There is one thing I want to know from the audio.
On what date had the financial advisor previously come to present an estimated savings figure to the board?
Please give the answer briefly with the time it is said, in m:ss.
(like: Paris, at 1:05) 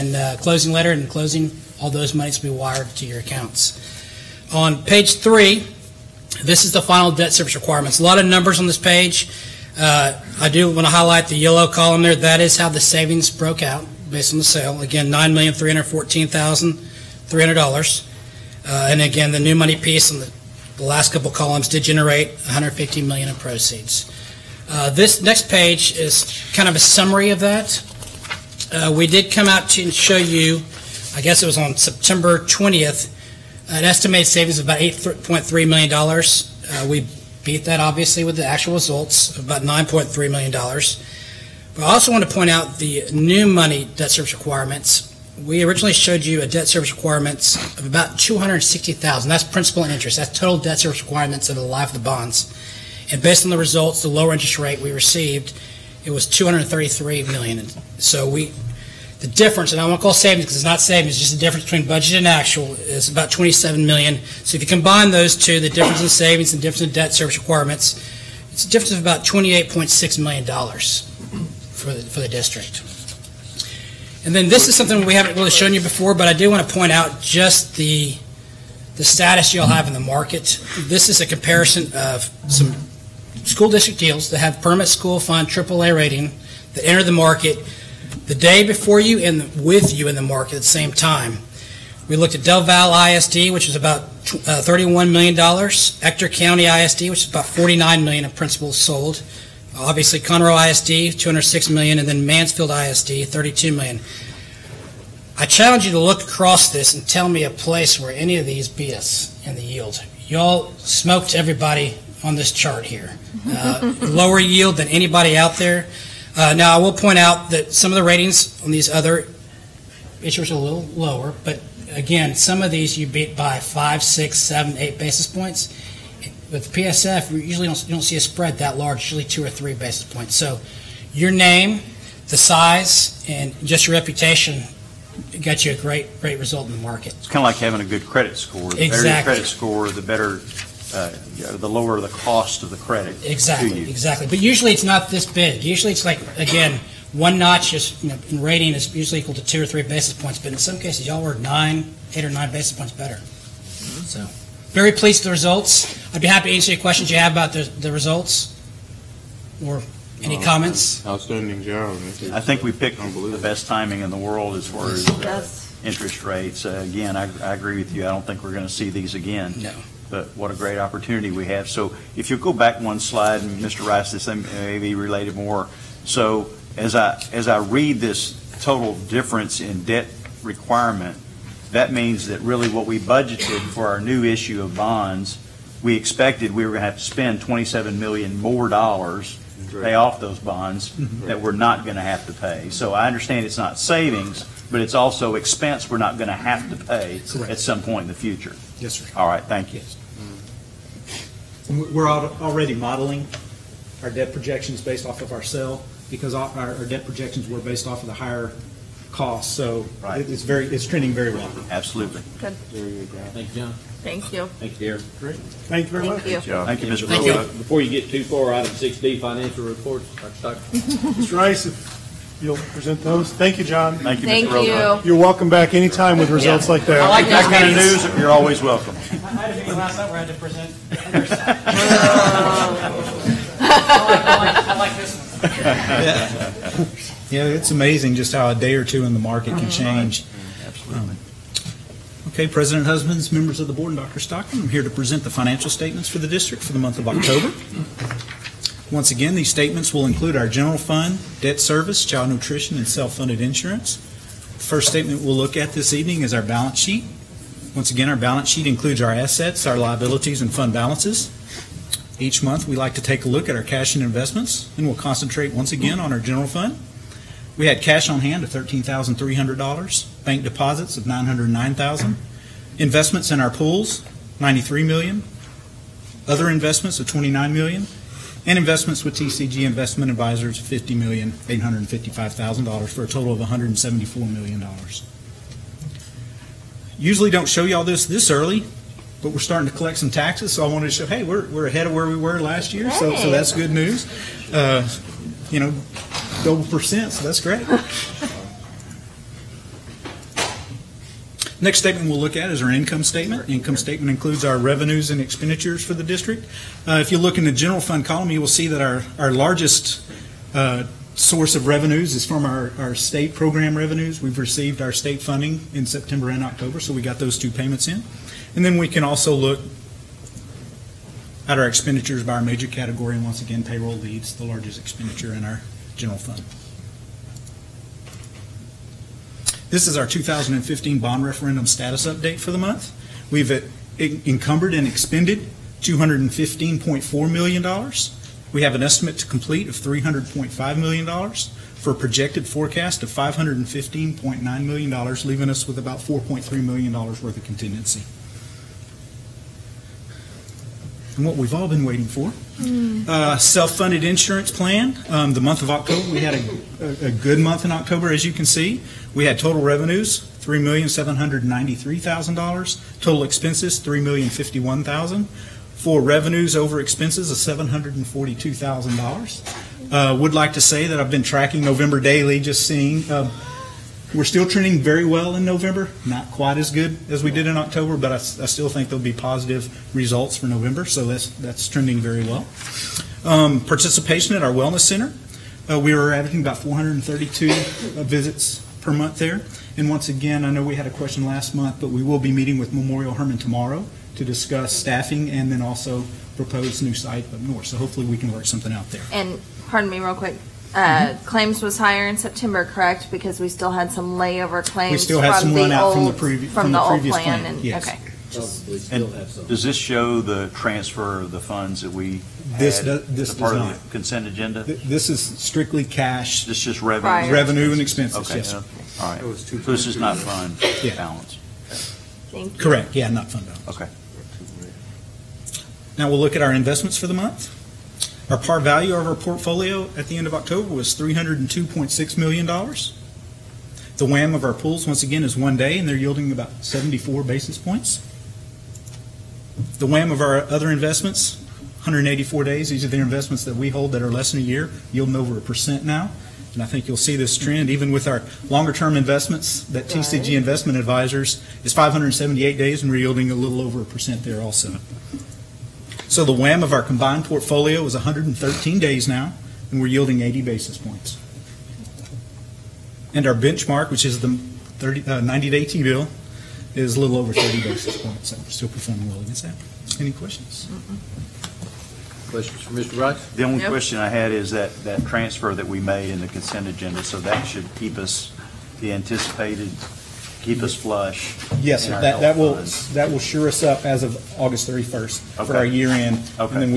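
September 20th, at 0:31.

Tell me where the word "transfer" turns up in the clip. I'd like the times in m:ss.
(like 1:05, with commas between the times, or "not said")
6:50, 7:55.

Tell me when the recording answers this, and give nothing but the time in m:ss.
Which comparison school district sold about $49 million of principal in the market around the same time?
1:35.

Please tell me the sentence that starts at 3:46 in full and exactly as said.
I like That kind of news, you're always welcome.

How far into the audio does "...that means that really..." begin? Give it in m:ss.
3:01.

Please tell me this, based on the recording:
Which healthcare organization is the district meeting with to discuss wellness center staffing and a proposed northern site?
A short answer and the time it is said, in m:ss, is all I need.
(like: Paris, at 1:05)
Memorial Hermann, at 6:32.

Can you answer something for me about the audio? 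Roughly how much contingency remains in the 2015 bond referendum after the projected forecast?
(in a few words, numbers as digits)
$4.3 million.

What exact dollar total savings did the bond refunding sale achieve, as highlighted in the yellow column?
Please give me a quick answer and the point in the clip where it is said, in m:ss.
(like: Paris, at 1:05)
$9,314,300, at 0:15.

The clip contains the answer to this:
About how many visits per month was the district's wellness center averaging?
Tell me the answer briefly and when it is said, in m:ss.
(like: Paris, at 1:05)
432, at 6:26.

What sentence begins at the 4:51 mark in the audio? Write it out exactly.
Hey, we're, we're ahead of where we were last year, so so that's good news.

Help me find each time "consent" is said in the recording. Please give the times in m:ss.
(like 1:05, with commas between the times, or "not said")
6:53, 7:56.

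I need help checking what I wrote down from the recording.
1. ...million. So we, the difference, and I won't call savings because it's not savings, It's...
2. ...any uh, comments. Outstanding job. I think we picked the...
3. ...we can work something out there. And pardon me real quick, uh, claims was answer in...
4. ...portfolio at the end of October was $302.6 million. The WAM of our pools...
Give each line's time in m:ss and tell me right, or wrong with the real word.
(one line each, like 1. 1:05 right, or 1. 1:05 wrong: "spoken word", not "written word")
1. 0:57 right
2. 2:40 right
3. 6:38 wrong: "higher", not "answer"
4. 7:09 right.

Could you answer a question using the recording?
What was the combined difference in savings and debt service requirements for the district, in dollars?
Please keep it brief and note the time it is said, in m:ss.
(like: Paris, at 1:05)
$28.6 million, at 1:09.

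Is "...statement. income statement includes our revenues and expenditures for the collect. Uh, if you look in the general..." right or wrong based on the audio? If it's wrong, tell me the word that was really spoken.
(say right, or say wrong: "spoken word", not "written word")
wrong: "district", not "collect".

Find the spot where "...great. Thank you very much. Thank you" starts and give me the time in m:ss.
3:35.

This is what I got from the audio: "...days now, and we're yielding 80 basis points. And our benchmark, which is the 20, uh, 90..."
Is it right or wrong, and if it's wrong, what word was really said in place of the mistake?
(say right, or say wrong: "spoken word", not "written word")
wrong: "30", not "20".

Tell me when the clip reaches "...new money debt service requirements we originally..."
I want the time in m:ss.
0:43.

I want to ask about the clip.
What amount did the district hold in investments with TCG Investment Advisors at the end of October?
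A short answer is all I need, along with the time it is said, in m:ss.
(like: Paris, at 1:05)
$50,855,000, at 4:40.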